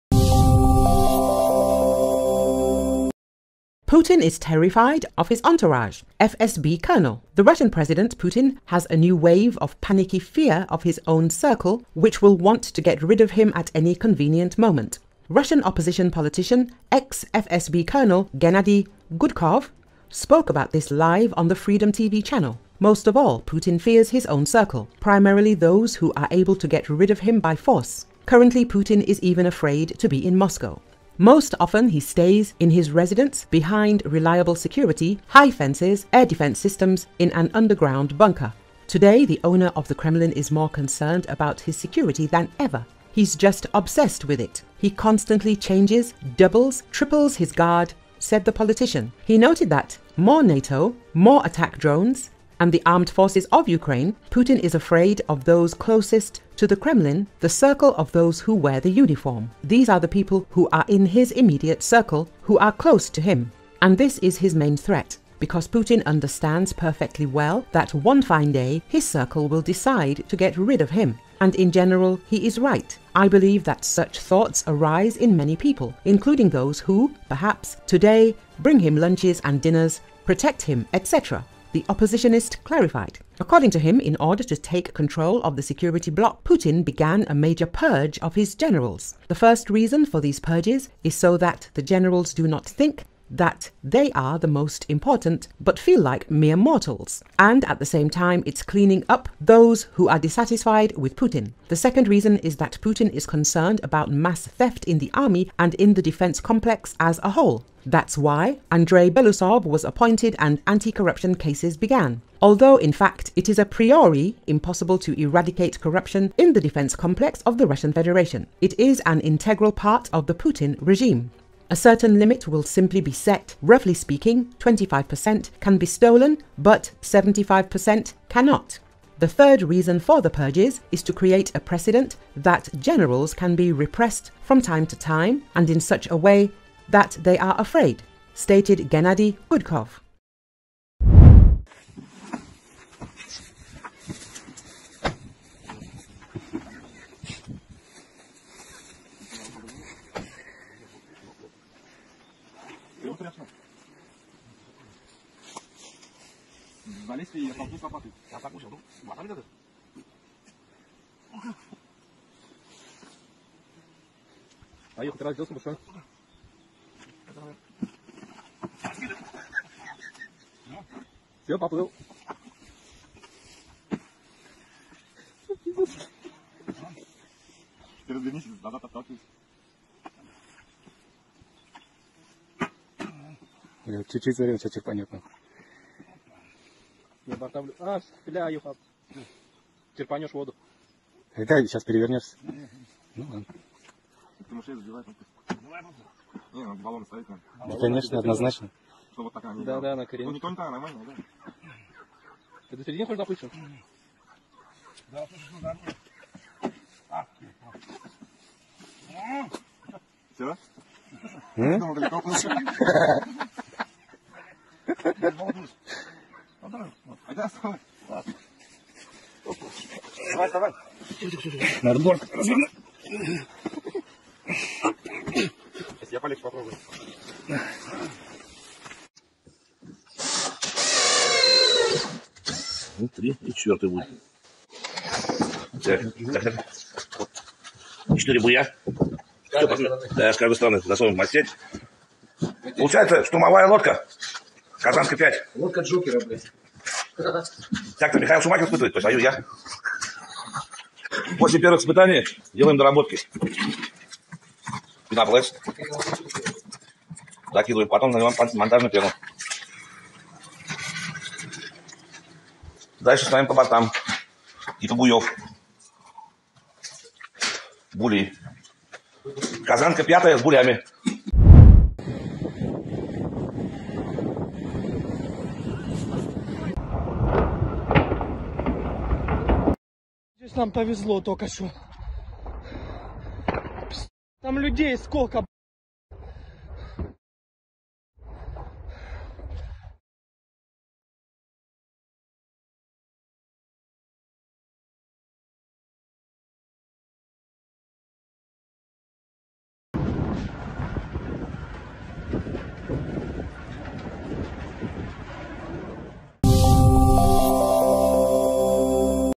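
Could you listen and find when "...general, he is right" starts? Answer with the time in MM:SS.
01:11.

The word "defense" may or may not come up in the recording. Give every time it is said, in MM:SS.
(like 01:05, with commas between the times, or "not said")
00:36, 01:46, 01:56.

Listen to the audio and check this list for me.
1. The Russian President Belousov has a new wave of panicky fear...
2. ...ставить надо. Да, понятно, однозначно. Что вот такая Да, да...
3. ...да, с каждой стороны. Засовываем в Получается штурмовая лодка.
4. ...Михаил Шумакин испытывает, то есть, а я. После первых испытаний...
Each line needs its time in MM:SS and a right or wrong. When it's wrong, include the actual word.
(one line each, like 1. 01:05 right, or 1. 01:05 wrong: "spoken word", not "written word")
1. 00:07 wrong: "Putin", not "Belousov"
2. 03:17 wrong: "конечно", not "понятно"
3. 04:00 right
4. 04:08 right.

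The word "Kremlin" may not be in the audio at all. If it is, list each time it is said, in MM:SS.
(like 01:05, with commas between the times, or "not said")
00:39, 00:56.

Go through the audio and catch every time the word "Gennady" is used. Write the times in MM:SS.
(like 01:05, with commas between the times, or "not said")
00:18, 02:18.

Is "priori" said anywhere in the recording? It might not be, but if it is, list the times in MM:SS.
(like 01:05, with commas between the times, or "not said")
01:53.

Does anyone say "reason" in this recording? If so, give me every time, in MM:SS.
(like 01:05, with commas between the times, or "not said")
01:29, 01:42, 02:09.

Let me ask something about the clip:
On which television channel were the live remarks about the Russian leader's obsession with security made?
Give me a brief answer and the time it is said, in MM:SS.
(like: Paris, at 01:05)
Freedom, at 00:21.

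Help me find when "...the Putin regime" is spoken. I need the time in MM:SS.
02:00.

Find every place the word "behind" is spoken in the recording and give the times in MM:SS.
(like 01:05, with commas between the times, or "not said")
00:33.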